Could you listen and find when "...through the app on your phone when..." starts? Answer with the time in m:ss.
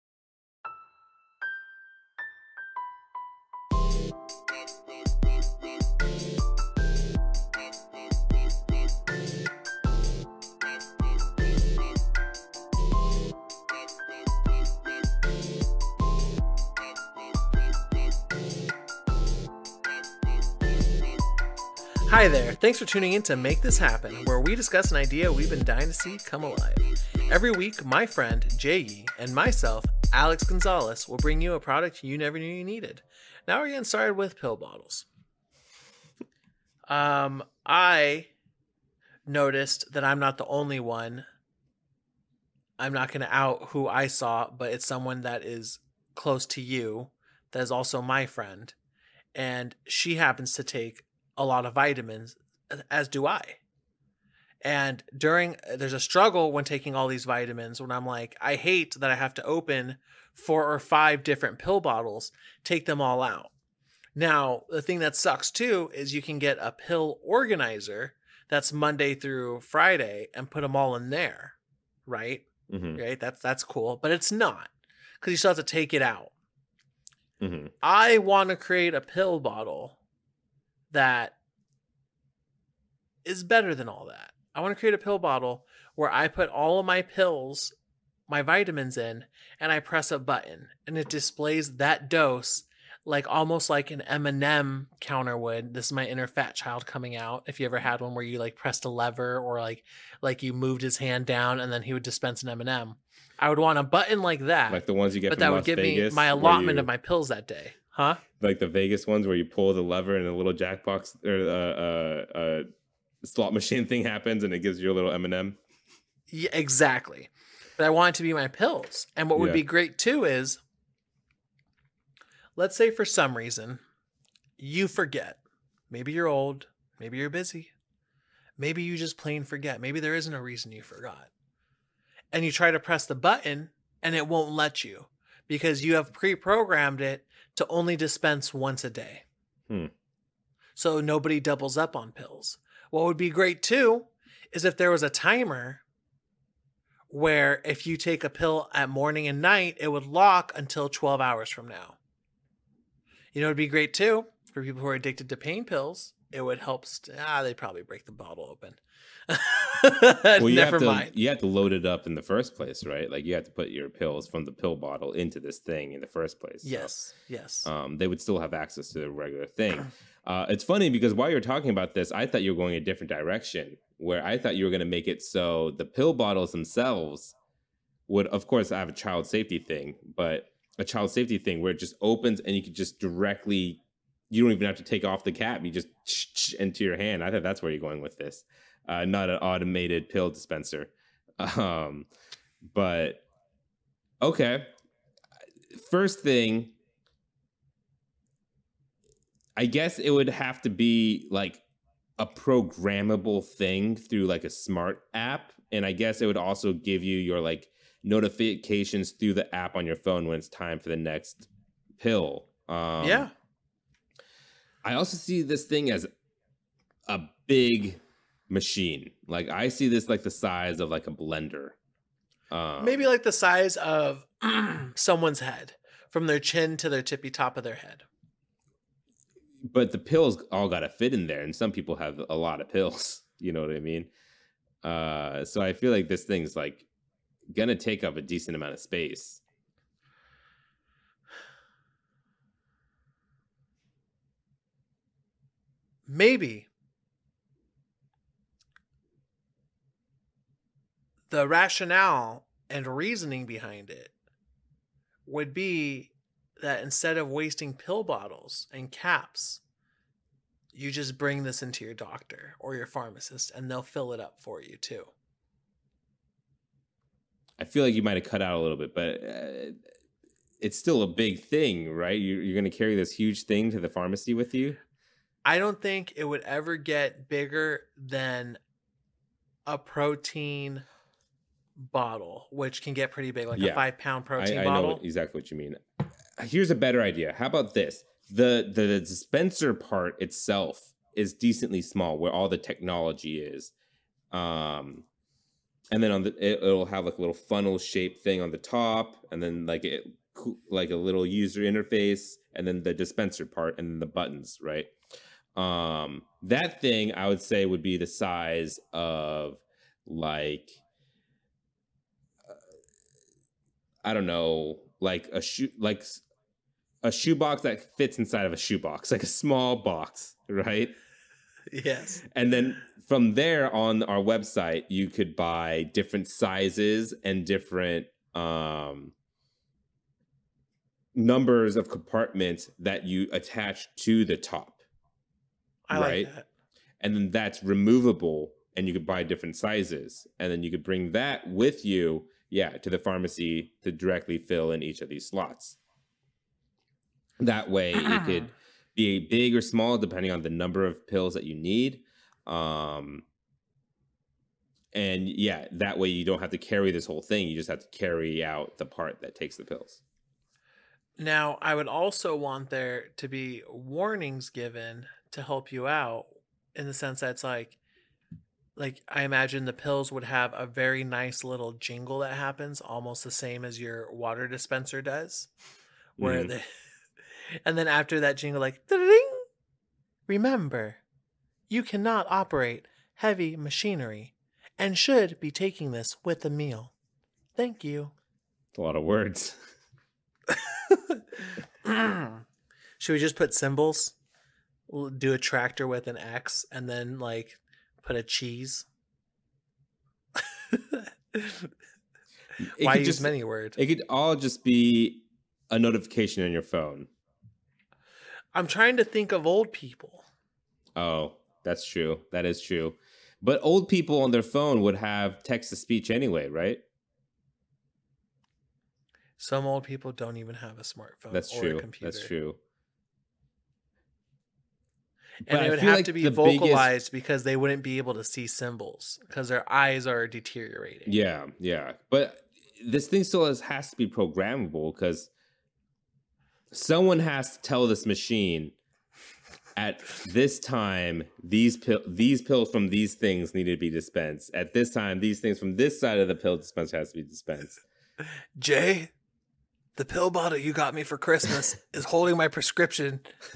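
3:29.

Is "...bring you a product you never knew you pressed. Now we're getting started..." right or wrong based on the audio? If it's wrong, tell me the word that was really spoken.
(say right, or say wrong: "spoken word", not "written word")
wrong: "needed", not "pressed".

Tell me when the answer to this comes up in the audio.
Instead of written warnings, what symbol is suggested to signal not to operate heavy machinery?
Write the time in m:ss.
6:35.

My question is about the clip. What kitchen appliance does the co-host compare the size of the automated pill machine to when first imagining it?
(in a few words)
a blender.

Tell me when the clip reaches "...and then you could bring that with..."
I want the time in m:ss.
5:40.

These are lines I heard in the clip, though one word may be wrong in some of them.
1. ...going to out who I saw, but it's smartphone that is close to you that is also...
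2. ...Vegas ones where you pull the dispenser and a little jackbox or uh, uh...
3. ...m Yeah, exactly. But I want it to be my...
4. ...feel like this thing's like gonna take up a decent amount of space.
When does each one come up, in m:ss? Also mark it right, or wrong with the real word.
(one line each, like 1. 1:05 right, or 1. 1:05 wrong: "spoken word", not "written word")
1. 0:43 wrong: "someone", not "smartphone"
2. 1:48 wrong: "lever", not "dispenser"
3. 1:55 right
4. 3:55 right.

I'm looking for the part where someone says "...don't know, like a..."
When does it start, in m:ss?
5:14.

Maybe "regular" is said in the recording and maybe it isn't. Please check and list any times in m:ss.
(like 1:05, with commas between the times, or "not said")
2:49.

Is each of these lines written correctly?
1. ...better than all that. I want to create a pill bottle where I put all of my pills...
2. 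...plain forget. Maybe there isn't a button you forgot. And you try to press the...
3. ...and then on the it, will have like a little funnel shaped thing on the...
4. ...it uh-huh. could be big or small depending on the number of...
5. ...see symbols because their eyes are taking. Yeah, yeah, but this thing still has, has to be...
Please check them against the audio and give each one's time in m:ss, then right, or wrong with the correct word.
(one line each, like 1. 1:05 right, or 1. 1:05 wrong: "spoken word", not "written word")
1. 1:23 right
2. 2:09 wrong: "reason", not "button"
3. 4:55 right
4. 5:47 right
5. 7:08 wrong: "deteriorating", not "taking".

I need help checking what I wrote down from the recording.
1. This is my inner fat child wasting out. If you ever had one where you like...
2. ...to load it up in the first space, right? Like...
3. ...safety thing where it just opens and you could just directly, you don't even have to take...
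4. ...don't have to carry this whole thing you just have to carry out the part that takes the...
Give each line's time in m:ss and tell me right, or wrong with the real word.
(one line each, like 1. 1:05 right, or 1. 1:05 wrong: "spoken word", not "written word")
1. 1:35 wrong: "coming", not "wasting"
2. 2:41 wrong: "place", not "space"
3. 3:01 right
4. 5:56 right.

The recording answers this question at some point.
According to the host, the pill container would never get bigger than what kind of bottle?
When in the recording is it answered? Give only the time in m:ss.
4:39.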